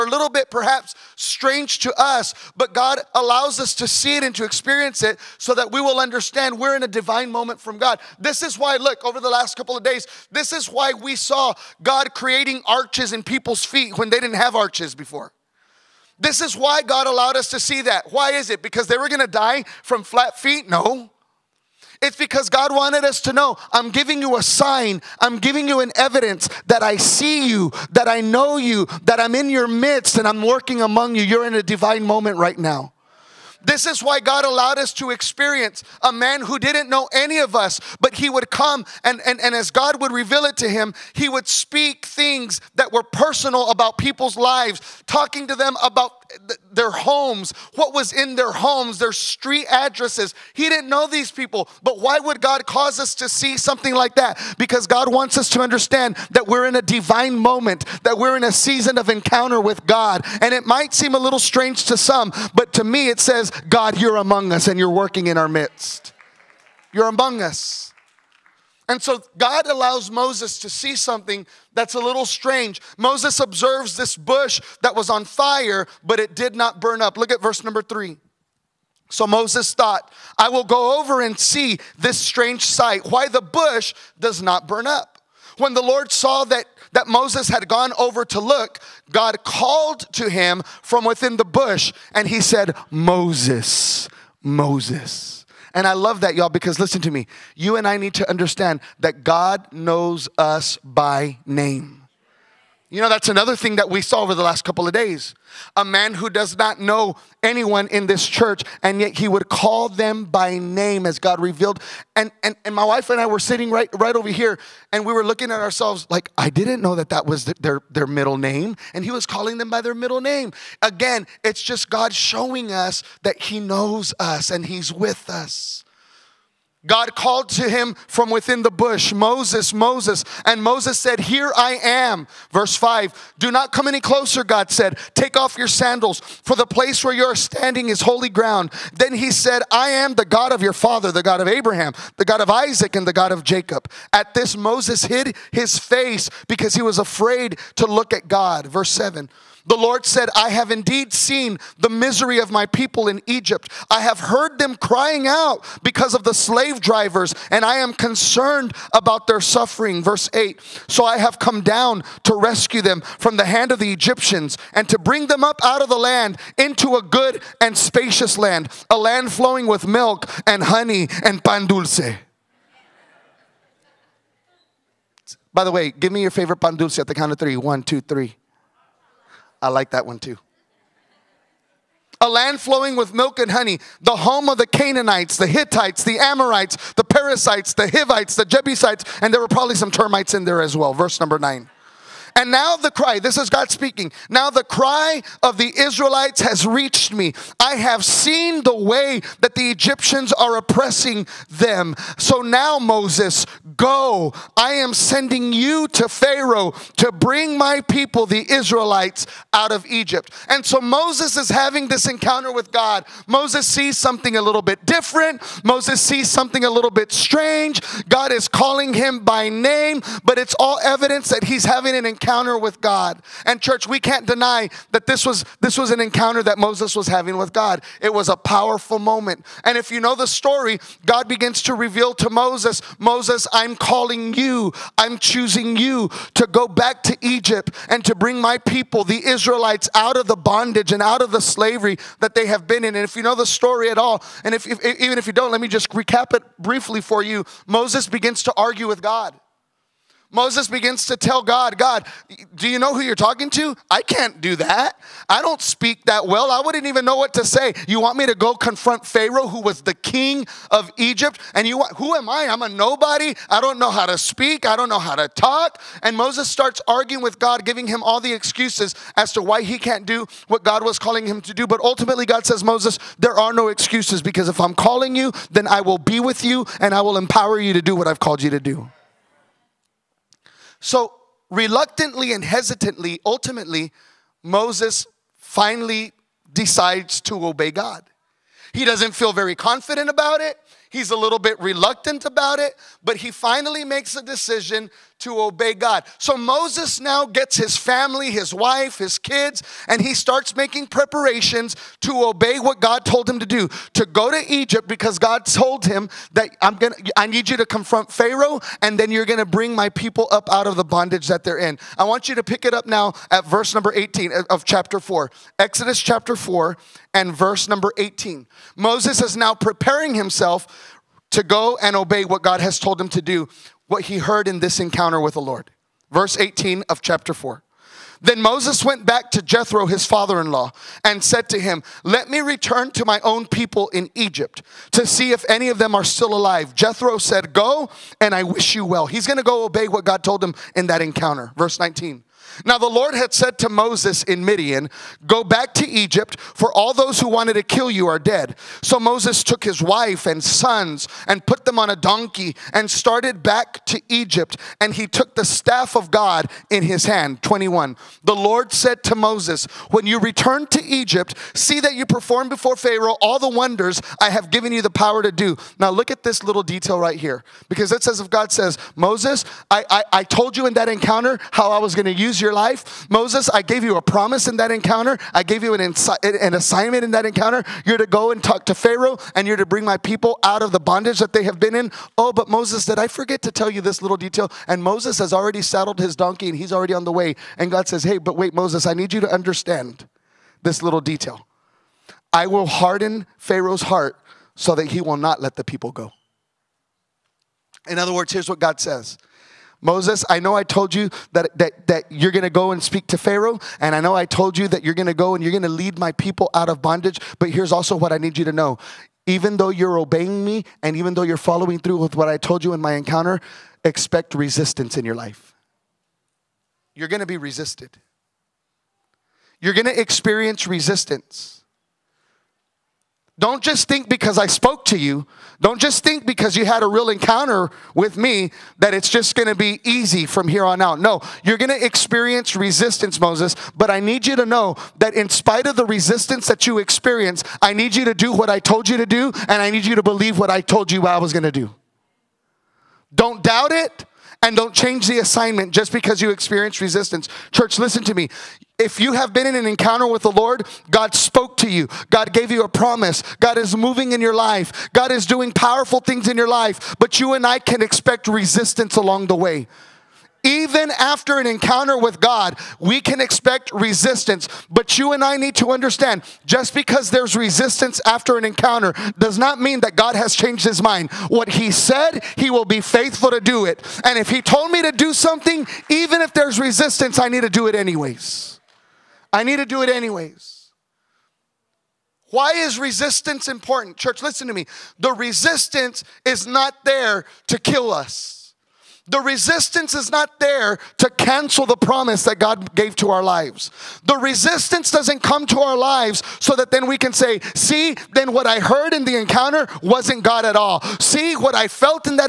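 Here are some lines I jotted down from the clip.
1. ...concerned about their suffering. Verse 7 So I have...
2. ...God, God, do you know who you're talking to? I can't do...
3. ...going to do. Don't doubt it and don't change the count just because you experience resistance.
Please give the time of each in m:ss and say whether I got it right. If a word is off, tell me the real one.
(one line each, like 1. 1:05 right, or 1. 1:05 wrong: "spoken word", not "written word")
1. 2:37 wrong: "8", not "7"
2. 4:11 right
3. 7:21 wrong: "assignment", not "count".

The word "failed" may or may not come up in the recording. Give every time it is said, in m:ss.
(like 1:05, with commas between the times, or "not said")
not said.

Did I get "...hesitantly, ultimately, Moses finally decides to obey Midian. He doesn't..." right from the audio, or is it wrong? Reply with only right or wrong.
wrong.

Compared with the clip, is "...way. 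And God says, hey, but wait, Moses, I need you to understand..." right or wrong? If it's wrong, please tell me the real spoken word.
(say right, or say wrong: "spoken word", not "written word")
right.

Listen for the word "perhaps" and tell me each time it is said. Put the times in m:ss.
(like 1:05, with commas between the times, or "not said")
0:00.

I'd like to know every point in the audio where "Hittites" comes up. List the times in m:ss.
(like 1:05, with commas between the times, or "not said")
3:05.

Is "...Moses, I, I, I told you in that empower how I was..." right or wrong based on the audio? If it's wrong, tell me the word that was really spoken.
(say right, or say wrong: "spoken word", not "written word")
wrong: "encounter", not "empower".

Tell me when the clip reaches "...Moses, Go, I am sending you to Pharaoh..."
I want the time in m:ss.
3:22.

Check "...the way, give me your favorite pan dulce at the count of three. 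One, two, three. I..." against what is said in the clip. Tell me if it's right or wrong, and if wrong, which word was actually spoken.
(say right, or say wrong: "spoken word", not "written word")
right.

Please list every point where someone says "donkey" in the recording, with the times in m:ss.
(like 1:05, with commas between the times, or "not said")
5:51, 6:26.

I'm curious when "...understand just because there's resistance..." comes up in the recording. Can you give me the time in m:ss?
7:45.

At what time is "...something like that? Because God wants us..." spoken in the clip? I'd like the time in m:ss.
0:53.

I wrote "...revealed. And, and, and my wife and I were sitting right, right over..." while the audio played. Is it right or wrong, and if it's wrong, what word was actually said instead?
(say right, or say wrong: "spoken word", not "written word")
right.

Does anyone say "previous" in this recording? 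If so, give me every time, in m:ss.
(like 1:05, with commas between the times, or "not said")
not said.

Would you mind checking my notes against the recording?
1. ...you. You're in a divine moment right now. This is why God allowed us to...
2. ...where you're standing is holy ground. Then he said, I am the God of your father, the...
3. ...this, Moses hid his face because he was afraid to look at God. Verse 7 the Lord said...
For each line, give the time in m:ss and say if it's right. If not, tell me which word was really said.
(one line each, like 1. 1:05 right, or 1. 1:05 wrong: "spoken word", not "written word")
1. 0:31 right
2. 2:17 right
3. 2:24 right.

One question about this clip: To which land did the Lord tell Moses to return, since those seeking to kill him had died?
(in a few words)
Midian.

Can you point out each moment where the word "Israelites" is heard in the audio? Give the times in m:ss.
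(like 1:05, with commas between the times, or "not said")
3:15, 3:28, 3:59.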